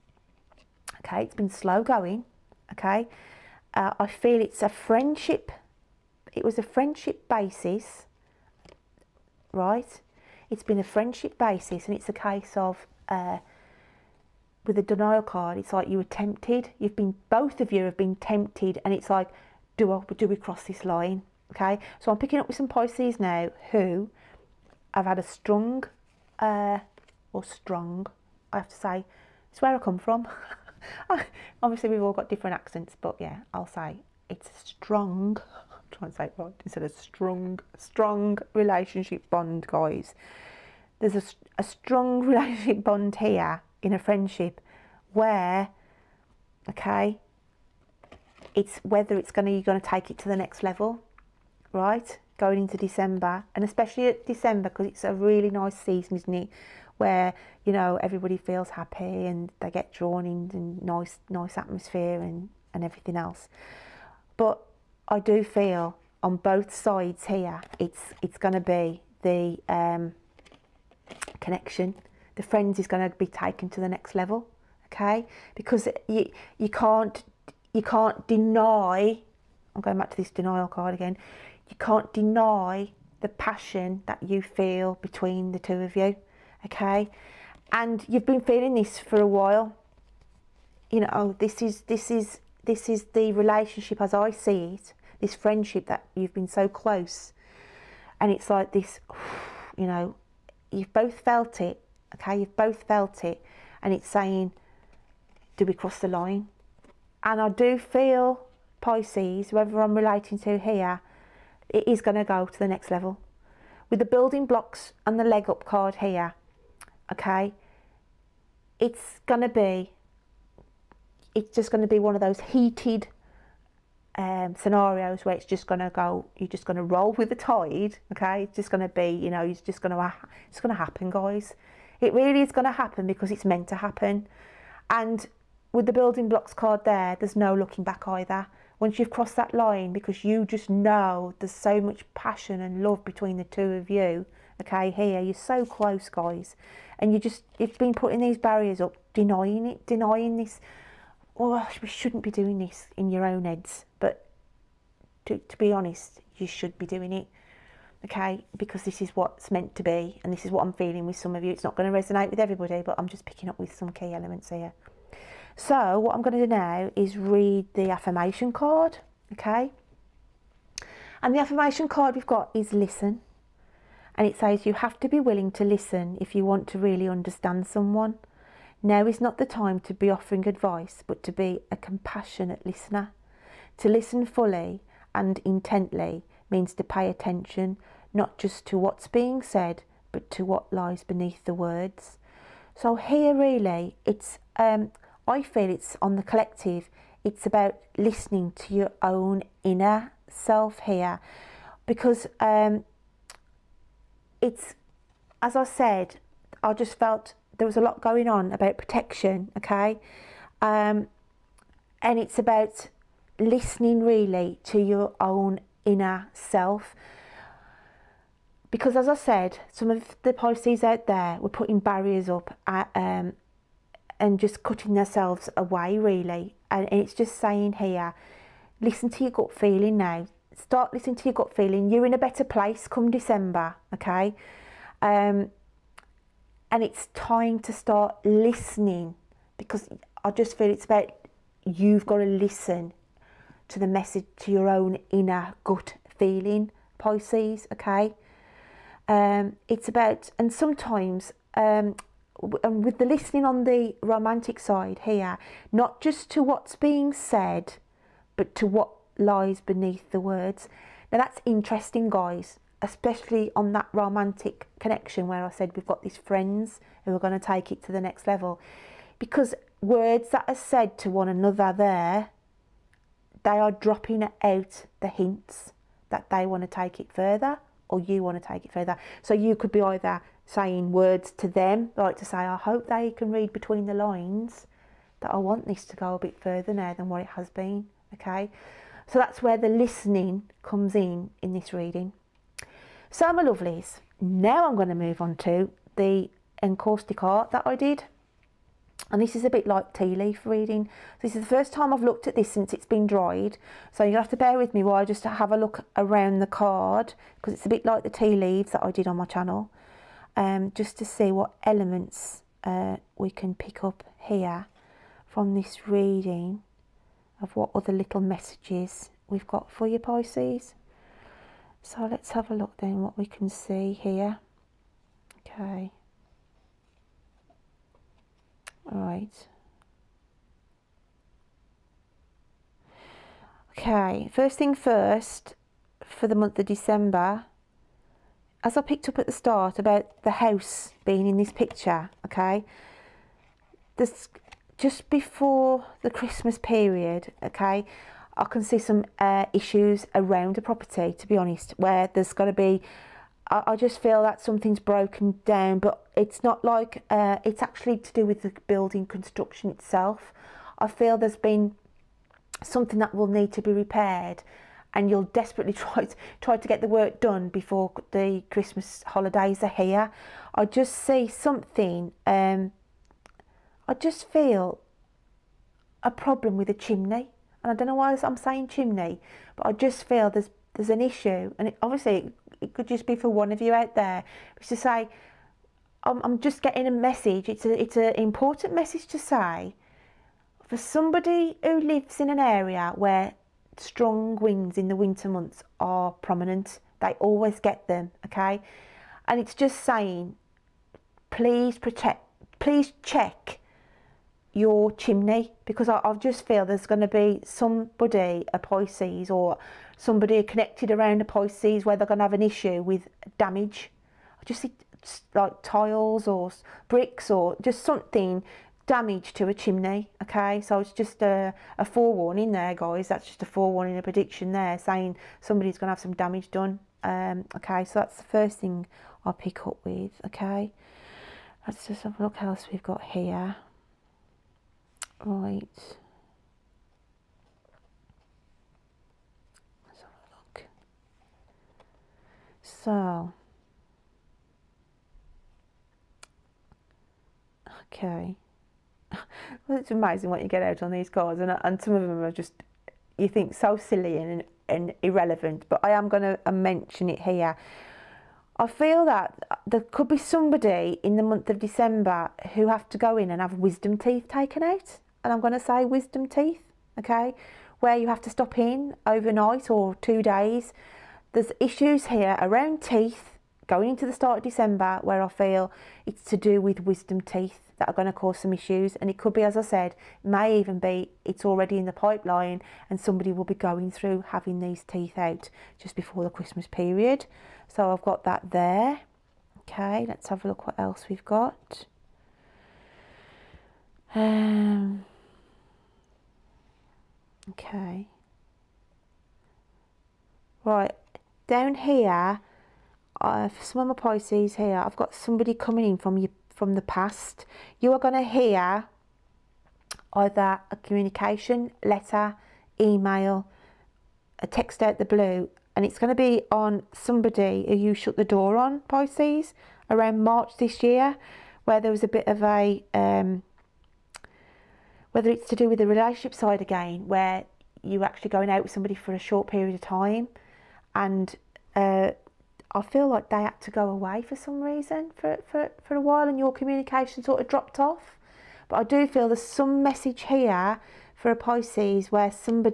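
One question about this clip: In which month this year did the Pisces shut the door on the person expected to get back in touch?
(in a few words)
March.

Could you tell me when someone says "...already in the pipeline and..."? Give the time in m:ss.
8:01.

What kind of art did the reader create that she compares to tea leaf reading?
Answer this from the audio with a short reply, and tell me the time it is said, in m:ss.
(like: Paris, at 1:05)
encaustic art, at 4:56.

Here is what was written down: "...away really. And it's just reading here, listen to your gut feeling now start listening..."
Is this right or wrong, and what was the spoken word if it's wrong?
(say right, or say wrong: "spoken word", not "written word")
wrong: "saying", not "reading".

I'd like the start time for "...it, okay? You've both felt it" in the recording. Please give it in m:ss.
1:41.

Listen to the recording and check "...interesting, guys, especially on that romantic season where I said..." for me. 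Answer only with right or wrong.
wrong.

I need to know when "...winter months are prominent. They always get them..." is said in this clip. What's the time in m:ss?
6:34.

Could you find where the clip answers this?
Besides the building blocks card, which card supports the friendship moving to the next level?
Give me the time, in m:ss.
1:55.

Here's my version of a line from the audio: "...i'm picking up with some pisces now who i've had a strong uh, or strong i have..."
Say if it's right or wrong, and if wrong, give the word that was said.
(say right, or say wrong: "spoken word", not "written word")
right.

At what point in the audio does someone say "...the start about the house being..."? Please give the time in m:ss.
5:39.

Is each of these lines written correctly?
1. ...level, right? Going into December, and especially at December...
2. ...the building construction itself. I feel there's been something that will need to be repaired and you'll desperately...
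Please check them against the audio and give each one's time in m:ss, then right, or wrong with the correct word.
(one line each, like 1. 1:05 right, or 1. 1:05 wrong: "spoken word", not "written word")
1. 0:50 right
2. 5:58 right.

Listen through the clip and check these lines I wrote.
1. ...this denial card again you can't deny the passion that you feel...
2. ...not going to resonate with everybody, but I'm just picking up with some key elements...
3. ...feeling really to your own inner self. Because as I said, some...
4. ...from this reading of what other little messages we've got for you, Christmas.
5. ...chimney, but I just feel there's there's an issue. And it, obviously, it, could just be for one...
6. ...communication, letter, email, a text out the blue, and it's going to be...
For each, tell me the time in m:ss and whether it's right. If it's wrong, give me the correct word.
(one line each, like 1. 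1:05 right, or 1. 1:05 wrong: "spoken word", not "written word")
1. 1:20 right
2. 2:41 right
3. 3:33 wrong: "listening", not "feeling"
4. 5:15 wrong: "Pisces", not "Christmas"
5. 6:18 right
6. 8:30 right.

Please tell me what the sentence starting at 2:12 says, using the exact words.
It really is going to happen because it's meant to happen.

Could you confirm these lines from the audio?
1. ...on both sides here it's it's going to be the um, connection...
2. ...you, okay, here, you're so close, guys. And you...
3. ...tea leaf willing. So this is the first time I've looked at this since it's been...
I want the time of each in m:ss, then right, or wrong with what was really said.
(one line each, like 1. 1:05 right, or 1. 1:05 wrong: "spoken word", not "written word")
1. 1:06 right
2. 2:23 right
3. 4:59 wrong: "reading", not "willing".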